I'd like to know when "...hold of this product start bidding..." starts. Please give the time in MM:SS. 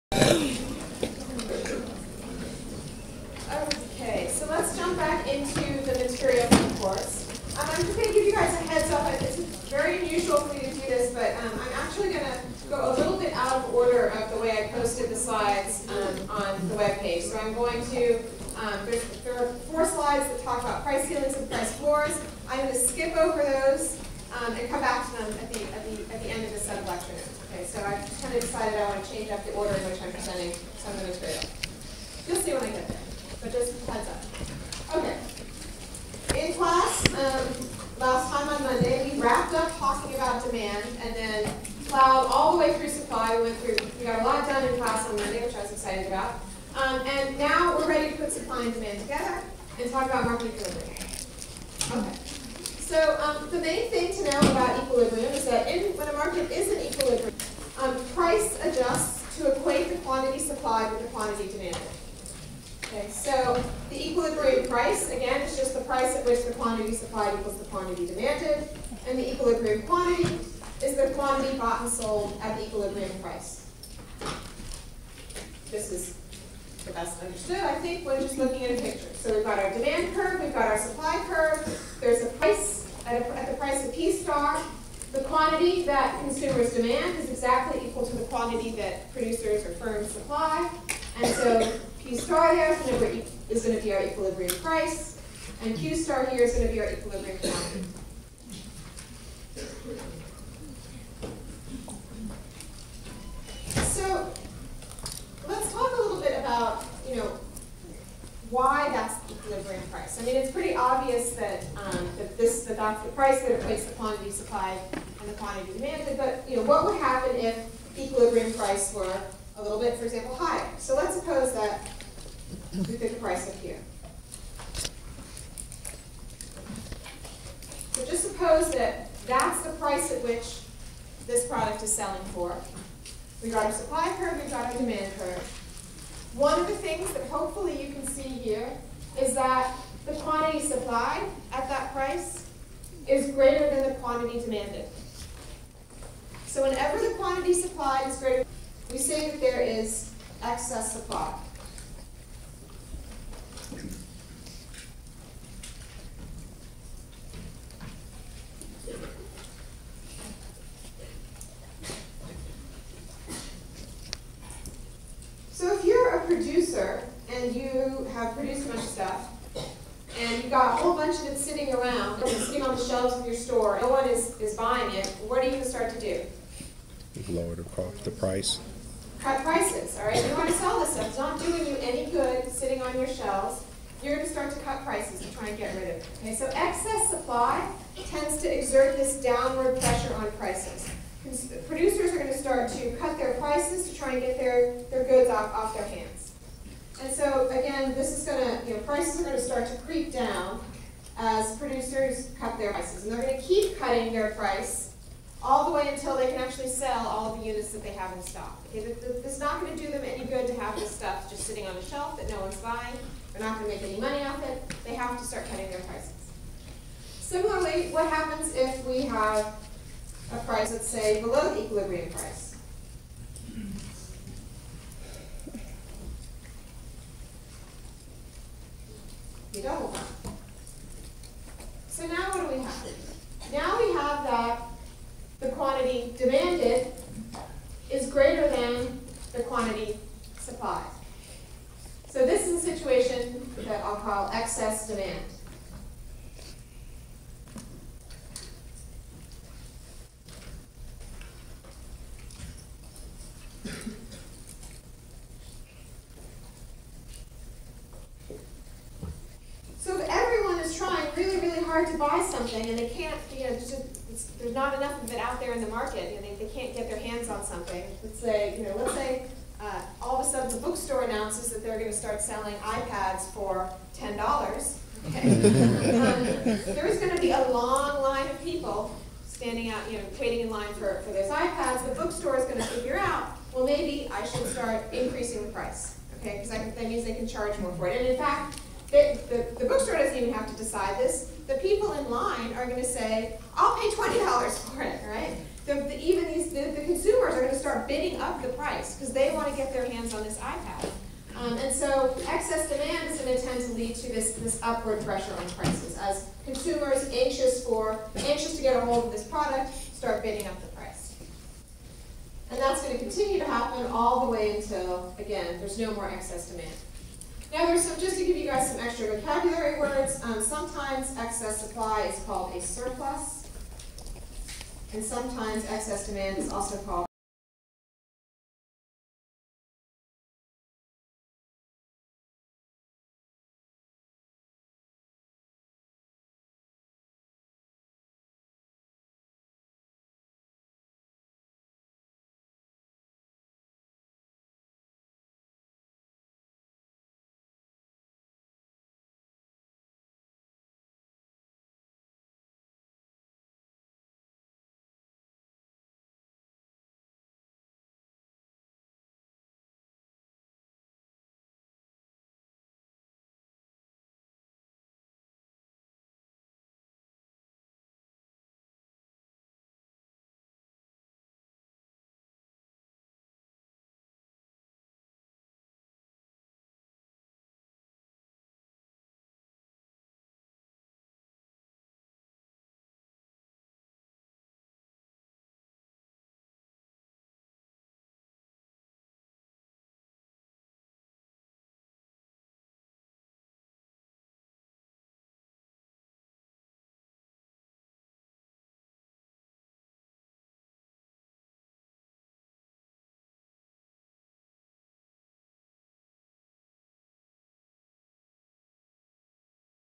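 05:08.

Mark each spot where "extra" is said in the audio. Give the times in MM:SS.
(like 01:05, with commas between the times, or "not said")
05:18.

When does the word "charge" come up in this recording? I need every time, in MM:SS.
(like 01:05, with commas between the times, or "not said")
04:47.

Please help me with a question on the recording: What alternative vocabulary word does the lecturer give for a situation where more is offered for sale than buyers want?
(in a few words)
surplus.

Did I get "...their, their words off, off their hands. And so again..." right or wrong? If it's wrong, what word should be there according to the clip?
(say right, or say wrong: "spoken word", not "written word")
wrong: "goods", not "words".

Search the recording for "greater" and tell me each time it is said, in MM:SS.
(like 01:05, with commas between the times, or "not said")
02:23, 02:28.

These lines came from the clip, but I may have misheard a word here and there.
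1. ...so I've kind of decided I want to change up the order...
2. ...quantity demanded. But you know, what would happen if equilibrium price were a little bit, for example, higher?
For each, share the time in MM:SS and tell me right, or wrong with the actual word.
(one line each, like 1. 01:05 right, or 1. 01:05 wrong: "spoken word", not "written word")
1. 00:27 right
2. 01:55 right.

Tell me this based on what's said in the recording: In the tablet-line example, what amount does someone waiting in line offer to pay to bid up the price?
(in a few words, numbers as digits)
$20.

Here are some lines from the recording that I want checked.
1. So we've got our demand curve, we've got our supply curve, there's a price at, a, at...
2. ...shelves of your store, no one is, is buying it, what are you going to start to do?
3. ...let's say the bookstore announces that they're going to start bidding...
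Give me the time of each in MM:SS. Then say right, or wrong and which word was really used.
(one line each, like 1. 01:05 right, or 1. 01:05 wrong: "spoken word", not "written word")
1. 01:19 right
2. 02:52 right
3. 04:28 wrong: "selling", not "bidding".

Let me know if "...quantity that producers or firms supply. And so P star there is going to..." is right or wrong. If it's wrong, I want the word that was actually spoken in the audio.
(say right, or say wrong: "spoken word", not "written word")
right.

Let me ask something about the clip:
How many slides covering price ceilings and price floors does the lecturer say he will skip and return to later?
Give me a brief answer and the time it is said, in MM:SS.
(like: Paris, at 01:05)
4, at 00:19.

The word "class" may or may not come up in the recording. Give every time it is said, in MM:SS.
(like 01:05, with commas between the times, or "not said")
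00:36, 00:44.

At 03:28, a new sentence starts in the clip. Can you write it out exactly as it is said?
Okay, it's not going to do them any good to have this stuff just sitting on a shelf that no one's buying.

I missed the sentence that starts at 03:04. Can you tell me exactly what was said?
You're going to start to cut prices to try and get rid of it.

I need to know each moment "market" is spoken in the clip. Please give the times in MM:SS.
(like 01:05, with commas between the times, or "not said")
00:50, 00:56, 04:25.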